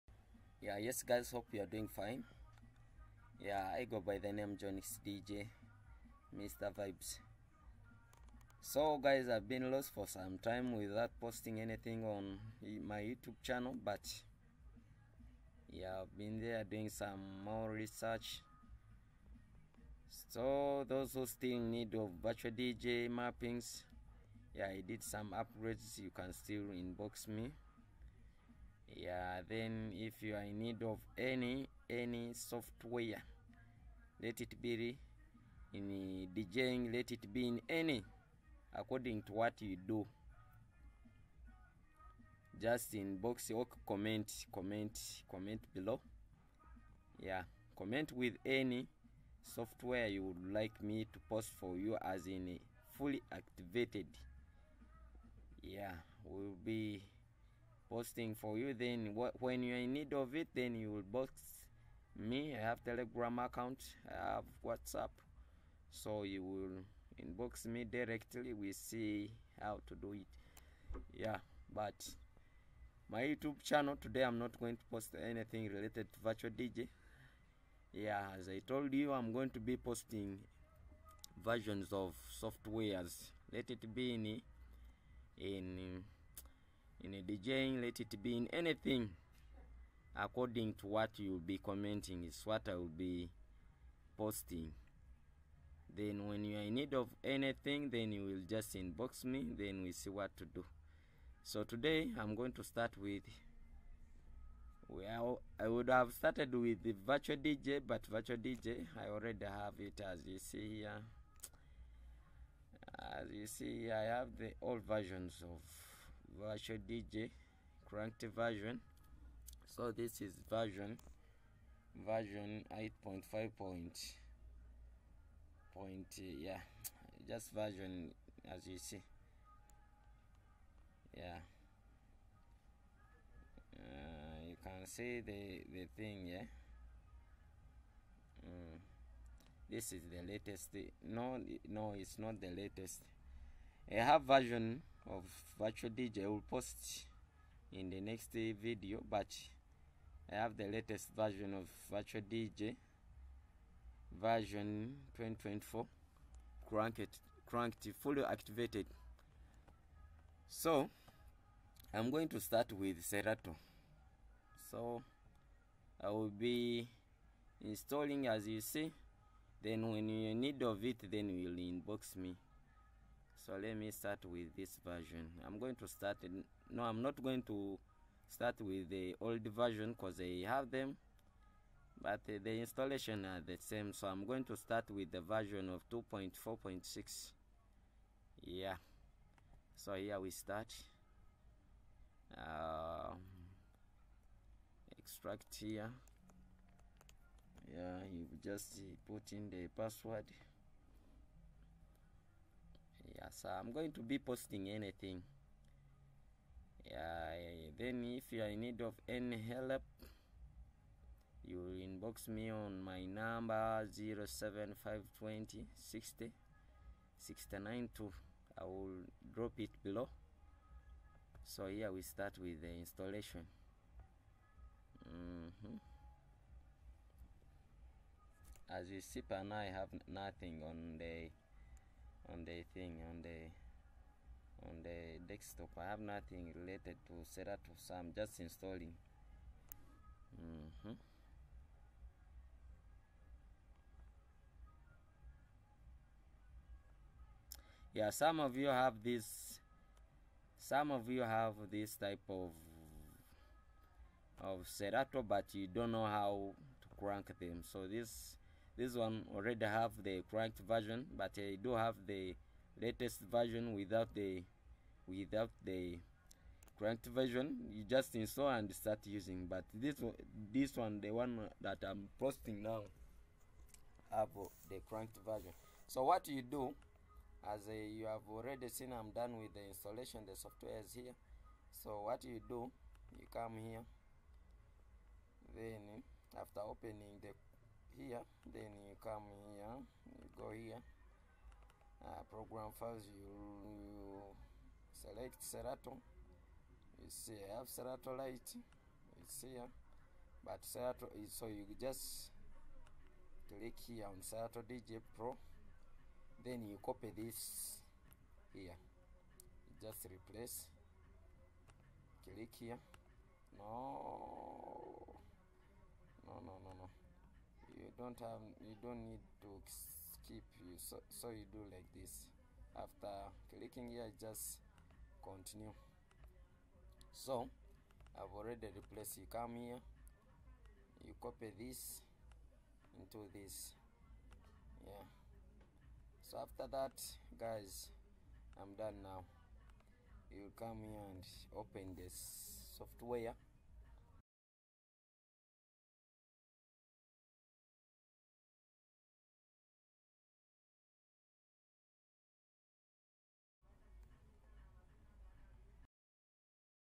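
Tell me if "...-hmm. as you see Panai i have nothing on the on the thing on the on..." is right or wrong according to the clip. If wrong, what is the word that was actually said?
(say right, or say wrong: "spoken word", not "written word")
right.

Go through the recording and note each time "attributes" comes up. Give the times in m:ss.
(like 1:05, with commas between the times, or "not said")
not said.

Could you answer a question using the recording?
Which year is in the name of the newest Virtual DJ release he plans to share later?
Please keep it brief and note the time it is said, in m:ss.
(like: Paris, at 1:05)
2024, at 2:35.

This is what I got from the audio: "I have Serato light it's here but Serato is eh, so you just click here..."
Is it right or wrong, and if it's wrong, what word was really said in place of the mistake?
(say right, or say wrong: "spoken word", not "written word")
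right.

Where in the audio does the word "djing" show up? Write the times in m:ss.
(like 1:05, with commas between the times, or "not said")
0:36, 1:27.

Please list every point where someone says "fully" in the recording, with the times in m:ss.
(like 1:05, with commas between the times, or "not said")
0:52, 2:38.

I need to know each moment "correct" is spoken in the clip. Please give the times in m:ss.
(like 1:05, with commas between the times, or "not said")
4:20, 4:26, 4:34.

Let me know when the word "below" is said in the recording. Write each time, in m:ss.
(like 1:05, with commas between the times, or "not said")
0:45, 3:39.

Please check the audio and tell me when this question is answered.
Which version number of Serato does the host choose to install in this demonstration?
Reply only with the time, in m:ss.
3:05.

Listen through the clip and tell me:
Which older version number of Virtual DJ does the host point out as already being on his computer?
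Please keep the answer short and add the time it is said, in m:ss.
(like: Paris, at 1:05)
8.5, at 2:02.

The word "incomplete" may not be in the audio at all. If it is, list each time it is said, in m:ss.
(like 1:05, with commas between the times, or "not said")
not said.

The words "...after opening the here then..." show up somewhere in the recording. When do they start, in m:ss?
4:46.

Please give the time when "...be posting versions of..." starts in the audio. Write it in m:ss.
1:19.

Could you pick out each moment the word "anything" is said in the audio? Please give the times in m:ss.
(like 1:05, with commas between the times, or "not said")
0:11, 1:15, 1:28, 1:37, 3:24.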